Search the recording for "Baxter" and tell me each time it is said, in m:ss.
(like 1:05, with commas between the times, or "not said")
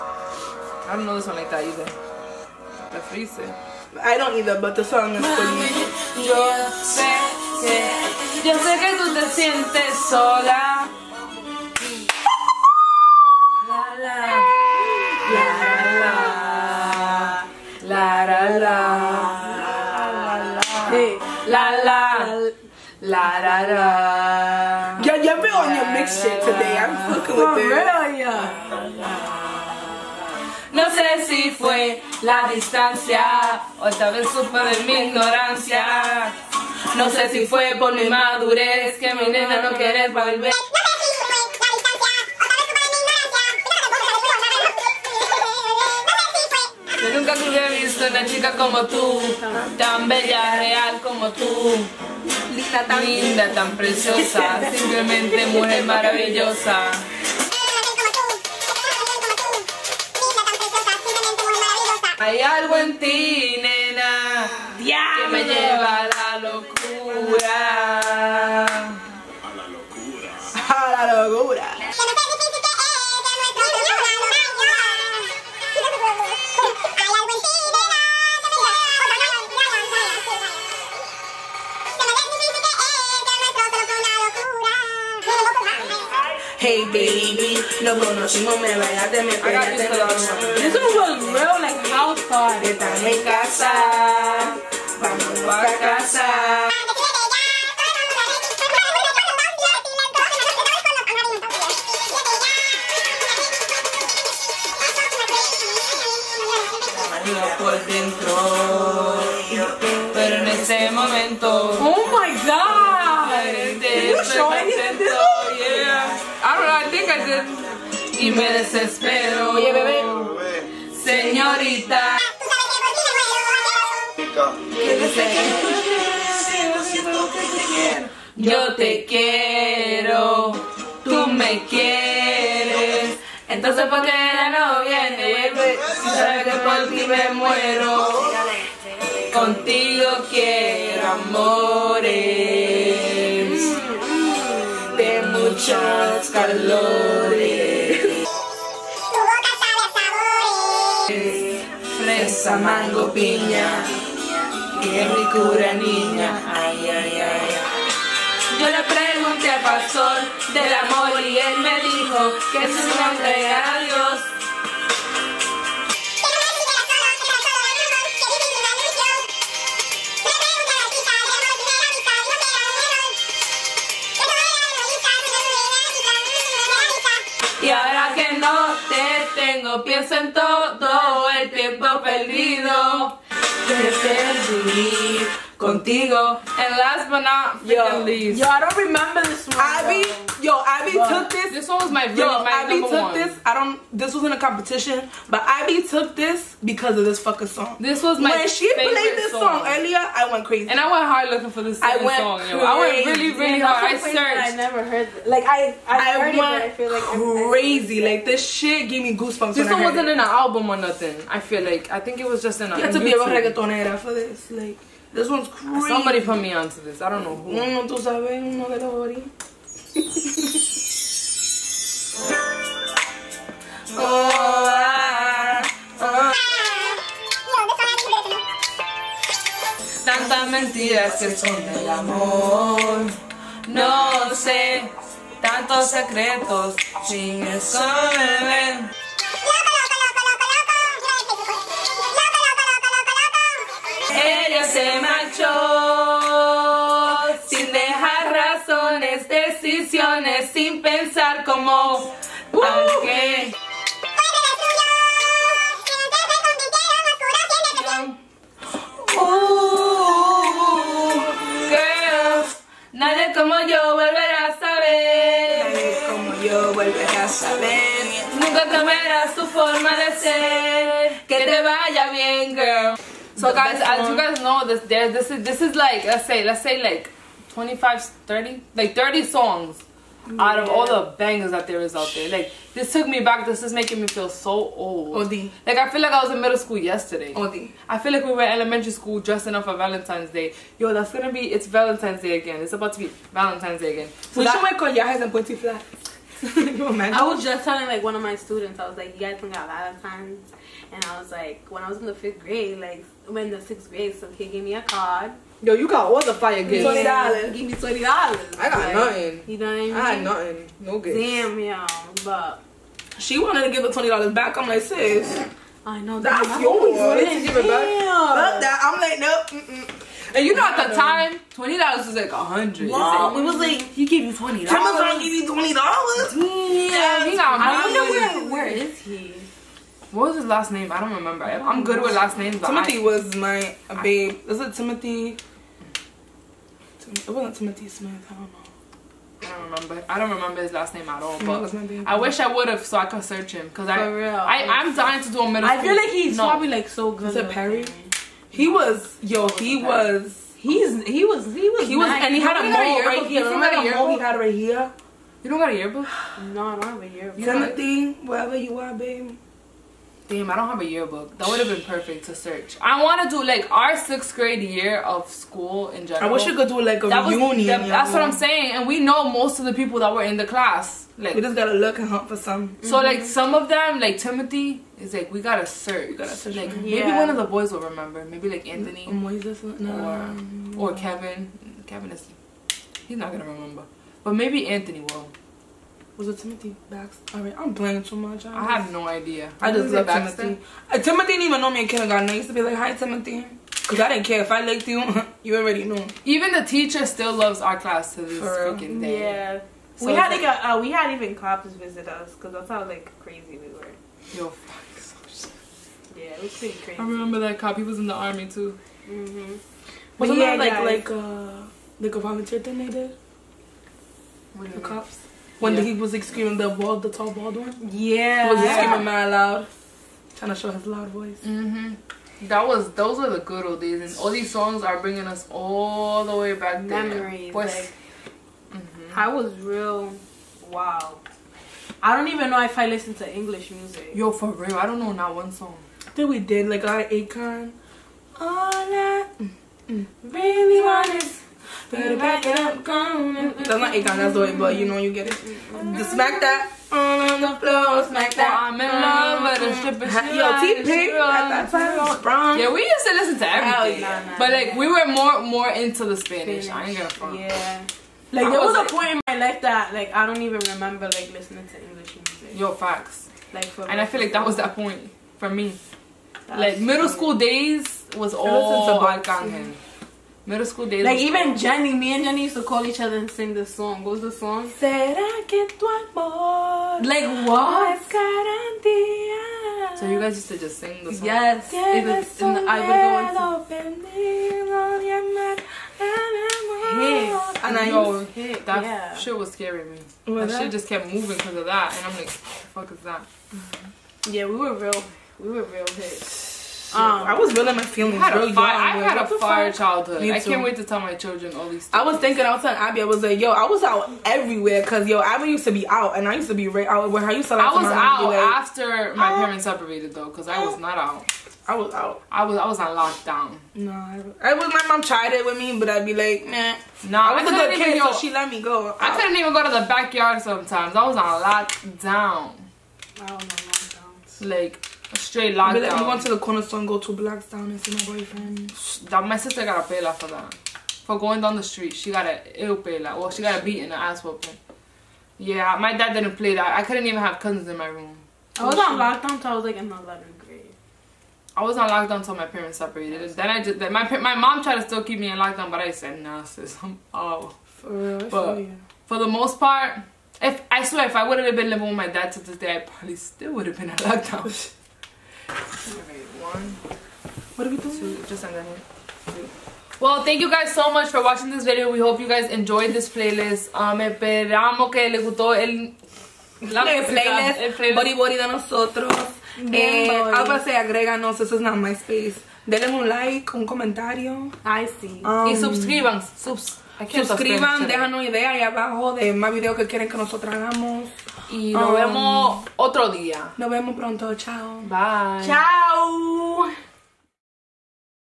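6:26.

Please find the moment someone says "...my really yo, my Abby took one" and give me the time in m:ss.
3:11.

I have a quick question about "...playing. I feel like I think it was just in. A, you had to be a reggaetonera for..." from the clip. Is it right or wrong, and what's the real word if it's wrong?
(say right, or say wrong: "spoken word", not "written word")
wrong: "nothing", not "playing".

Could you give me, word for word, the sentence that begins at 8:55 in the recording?
Yeah, my dad didn't play that.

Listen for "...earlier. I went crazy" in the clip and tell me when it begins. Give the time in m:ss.
3:19.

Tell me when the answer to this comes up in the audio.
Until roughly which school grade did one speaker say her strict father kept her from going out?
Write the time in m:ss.
8:59.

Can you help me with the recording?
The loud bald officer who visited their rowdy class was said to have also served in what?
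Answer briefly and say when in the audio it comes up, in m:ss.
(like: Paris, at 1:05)
the army, at 6:48.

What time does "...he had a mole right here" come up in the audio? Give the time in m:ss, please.
5:52.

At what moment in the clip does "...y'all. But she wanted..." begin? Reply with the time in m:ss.
5:11.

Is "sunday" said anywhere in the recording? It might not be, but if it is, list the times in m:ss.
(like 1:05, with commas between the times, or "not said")
not said.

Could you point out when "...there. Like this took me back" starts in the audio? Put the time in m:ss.
4:42.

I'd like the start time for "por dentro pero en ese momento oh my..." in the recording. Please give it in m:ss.
1:47.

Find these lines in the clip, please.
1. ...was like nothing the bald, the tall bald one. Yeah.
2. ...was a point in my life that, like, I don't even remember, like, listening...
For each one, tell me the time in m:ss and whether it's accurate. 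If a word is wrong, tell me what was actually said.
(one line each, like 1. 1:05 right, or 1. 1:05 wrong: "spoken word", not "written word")
1. 6:55 wrong: "screaming", not "nothing"
2. 7:38 right.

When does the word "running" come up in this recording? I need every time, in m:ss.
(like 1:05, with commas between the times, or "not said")
not said.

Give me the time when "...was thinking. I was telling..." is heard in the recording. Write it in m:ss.
8:22.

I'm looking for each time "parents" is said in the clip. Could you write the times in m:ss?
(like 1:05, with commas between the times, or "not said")
8:29, 9:02.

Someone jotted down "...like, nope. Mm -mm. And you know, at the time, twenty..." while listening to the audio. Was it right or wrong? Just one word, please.
right.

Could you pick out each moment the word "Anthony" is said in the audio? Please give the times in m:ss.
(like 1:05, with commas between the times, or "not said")
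6:18, 6:24.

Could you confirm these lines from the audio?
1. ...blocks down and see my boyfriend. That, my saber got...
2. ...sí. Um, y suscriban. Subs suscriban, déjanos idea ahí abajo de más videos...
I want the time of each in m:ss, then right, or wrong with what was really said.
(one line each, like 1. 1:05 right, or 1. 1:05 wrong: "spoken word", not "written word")
1. 8:47 wrong: "sister", not "saber"
2. 9:35 right.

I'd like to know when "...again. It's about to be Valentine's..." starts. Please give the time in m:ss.
4:52.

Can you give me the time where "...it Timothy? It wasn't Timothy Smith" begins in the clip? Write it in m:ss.
5:34.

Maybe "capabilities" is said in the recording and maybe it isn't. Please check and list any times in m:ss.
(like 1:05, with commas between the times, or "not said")
not said.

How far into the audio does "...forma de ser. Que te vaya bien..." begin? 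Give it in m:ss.
4:29.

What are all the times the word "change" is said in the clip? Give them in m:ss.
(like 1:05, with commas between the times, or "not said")
not said.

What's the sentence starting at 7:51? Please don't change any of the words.
Like even Jenny, me and Jenny used to call each other and sing this song.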